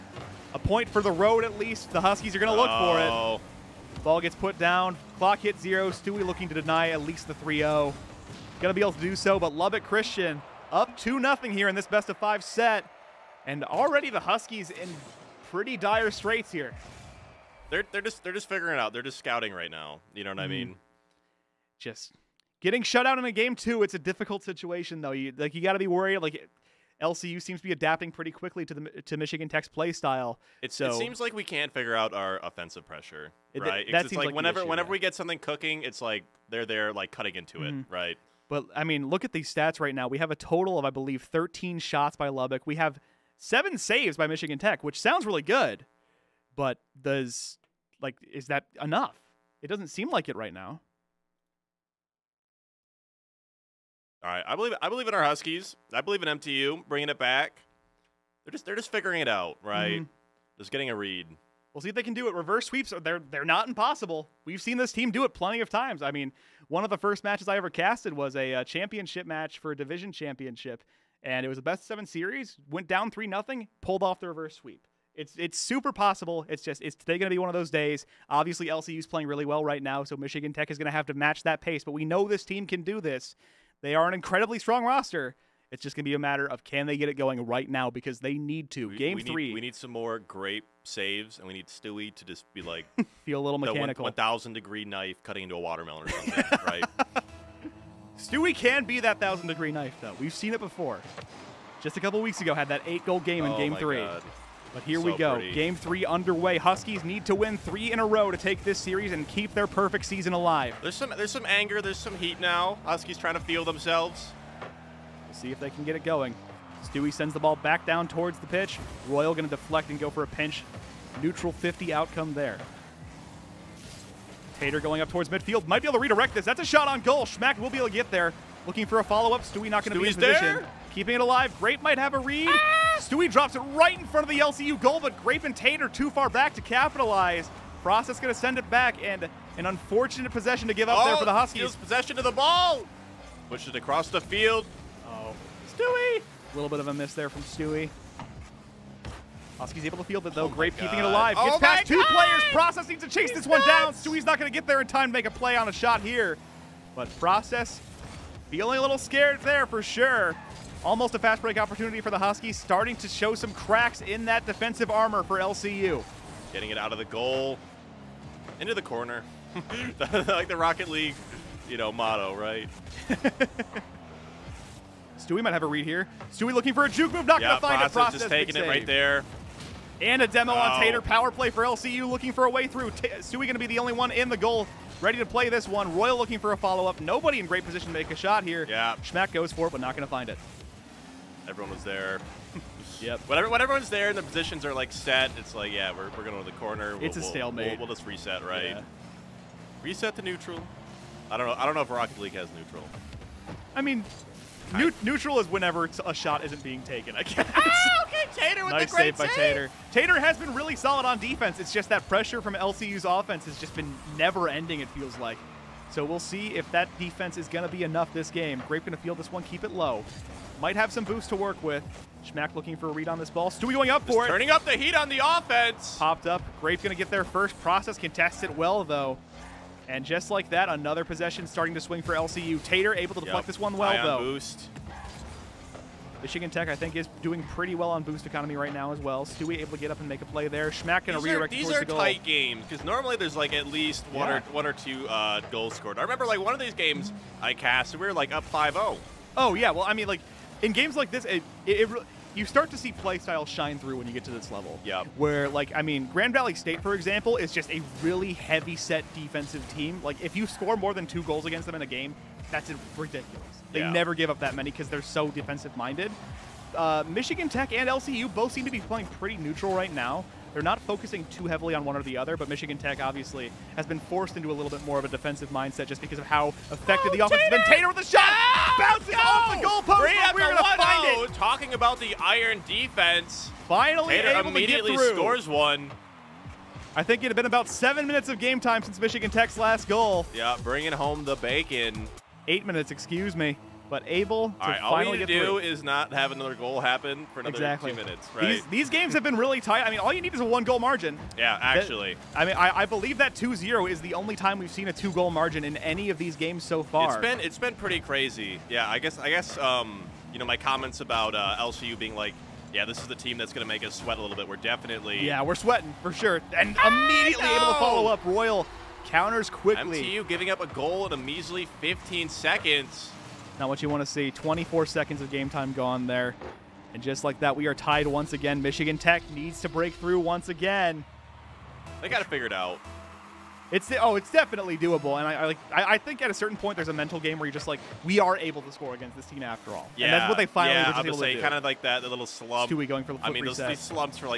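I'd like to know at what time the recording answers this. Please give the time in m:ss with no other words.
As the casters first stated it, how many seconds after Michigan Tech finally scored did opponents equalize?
5:21.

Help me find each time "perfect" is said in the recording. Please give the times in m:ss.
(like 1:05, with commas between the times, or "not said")
1:49.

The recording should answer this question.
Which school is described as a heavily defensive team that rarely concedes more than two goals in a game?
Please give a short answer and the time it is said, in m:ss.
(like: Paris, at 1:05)
Grand Valley State, at 4:16.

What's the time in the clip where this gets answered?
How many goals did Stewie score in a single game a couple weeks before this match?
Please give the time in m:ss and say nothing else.
1:42.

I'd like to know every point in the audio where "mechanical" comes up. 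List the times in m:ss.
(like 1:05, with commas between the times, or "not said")
1:33.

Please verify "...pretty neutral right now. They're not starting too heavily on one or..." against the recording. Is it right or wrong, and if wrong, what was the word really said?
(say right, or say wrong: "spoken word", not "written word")
wrong: "focusing", not "starting".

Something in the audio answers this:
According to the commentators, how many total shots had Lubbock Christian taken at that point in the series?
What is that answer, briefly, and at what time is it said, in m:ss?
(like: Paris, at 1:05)
13, at 0:41.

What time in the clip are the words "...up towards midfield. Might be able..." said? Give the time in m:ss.
2:05.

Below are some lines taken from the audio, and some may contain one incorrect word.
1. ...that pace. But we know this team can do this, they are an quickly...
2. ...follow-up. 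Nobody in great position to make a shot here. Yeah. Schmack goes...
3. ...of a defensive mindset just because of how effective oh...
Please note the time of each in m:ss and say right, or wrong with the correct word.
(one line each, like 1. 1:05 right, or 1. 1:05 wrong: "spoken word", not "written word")
1. 1:21 wrong: "incredibly", not "quickly"
2. 3:06 right
3. 4:34 right.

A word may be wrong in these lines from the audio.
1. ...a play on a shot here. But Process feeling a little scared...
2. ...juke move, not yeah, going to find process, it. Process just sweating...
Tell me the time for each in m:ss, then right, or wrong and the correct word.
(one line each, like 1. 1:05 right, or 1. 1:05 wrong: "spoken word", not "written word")
1. 2:35 right
2. 2:56 wrong: "taking", not "sweating".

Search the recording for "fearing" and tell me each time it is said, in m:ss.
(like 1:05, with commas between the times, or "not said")
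not said.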